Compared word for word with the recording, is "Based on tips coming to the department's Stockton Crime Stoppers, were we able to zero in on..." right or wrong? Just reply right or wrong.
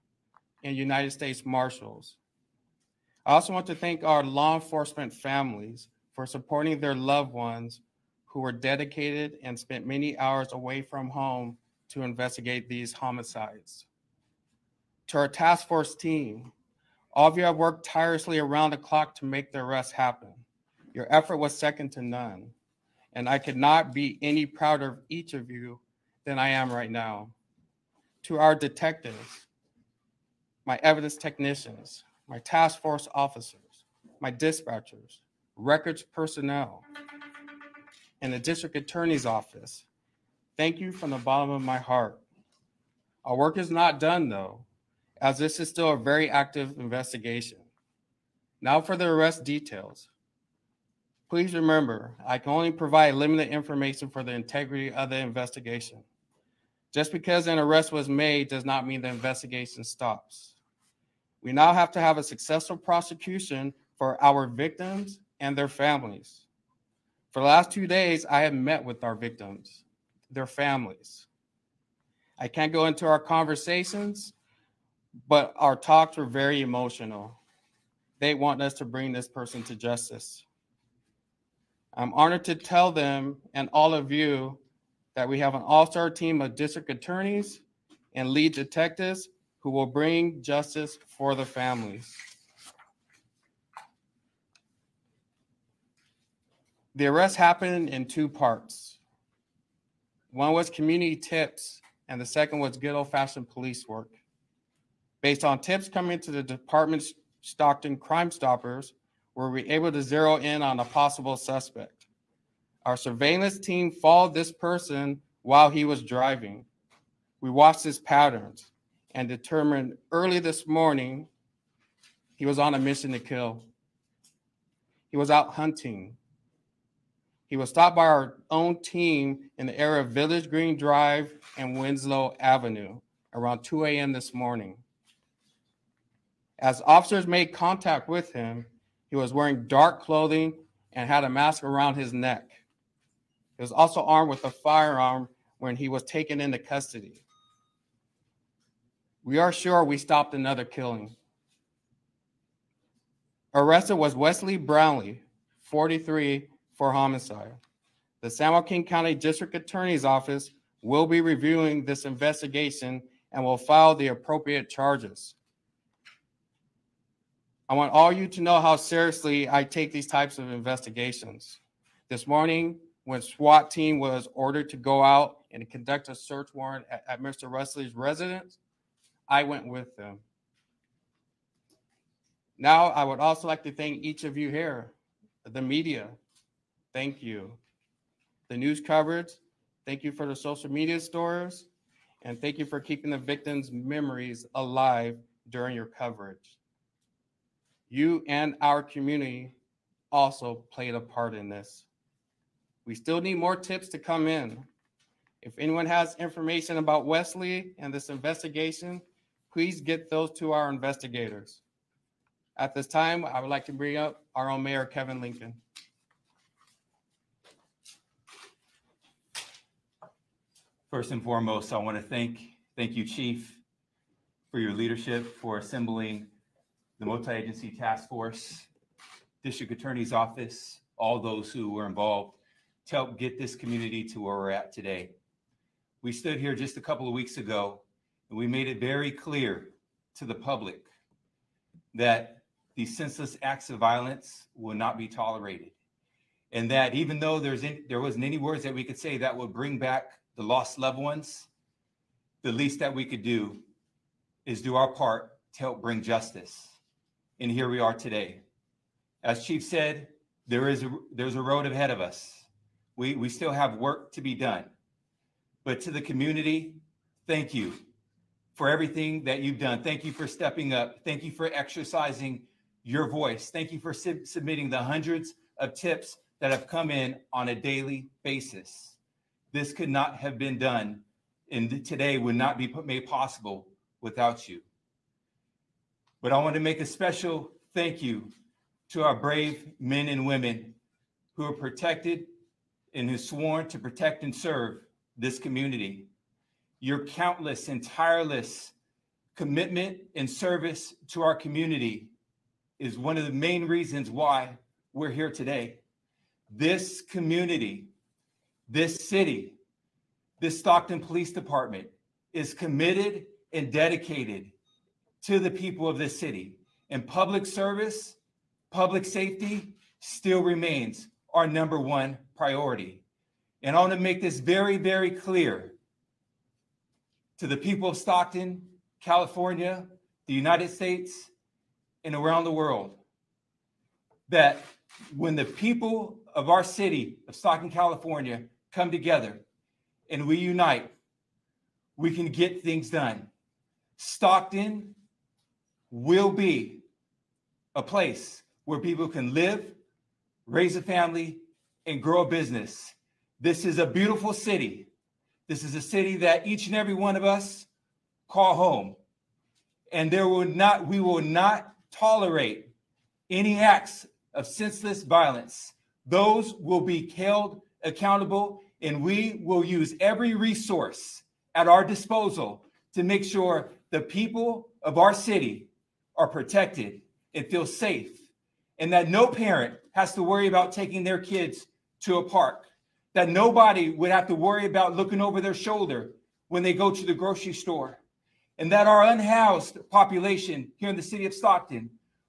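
right.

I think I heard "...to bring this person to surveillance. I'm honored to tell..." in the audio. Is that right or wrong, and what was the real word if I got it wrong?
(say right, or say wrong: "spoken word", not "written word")
wrong: "justice", not "surveillance".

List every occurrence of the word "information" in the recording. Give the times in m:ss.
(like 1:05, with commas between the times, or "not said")
0:53, 3:26.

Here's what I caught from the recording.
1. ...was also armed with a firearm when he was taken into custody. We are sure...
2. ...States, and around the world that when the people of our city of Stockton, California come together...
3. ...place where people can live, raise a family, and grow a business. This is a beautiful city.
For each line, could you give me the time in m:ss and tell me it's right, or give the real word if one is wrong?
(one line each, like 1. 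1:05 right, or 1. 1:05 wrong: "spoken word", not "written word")
1. 2:23 right
2. 5:30 right
3. 5:47 right.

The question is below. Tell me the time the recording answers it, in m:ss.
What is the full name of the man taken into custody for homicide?
2:34.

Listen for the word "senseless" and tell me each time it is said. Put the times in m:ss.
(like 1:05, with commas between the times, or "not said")
4:02, 6:04.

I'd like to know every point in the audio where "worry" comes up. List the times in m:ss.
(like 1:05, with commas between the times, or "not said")
6:20, 6:24.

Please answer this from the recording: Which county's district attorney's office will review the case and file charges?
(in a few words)
San Joaquin County.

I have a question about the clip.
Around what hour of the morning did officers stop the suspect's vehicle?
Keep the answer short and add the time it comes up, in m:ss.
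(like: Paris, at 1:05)
2 a.m., at 2:13.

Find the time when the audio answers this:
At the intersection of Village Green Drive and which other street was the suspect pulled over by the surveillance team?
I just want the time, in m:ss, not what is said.
2:11.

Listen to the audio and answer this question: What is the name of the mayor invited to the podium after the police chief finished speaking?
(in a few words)
Kevin Lincoln.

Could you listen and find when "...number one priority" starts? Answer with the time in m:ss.
5:21.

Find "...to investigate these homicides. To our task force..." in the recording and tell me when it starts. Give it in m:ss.
0:11.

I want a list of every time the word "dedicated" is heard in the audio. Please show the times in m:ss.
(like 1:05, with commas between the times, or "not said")
0:08, 5:13.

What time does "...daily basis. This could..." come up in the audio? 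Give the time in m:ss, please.
4:37.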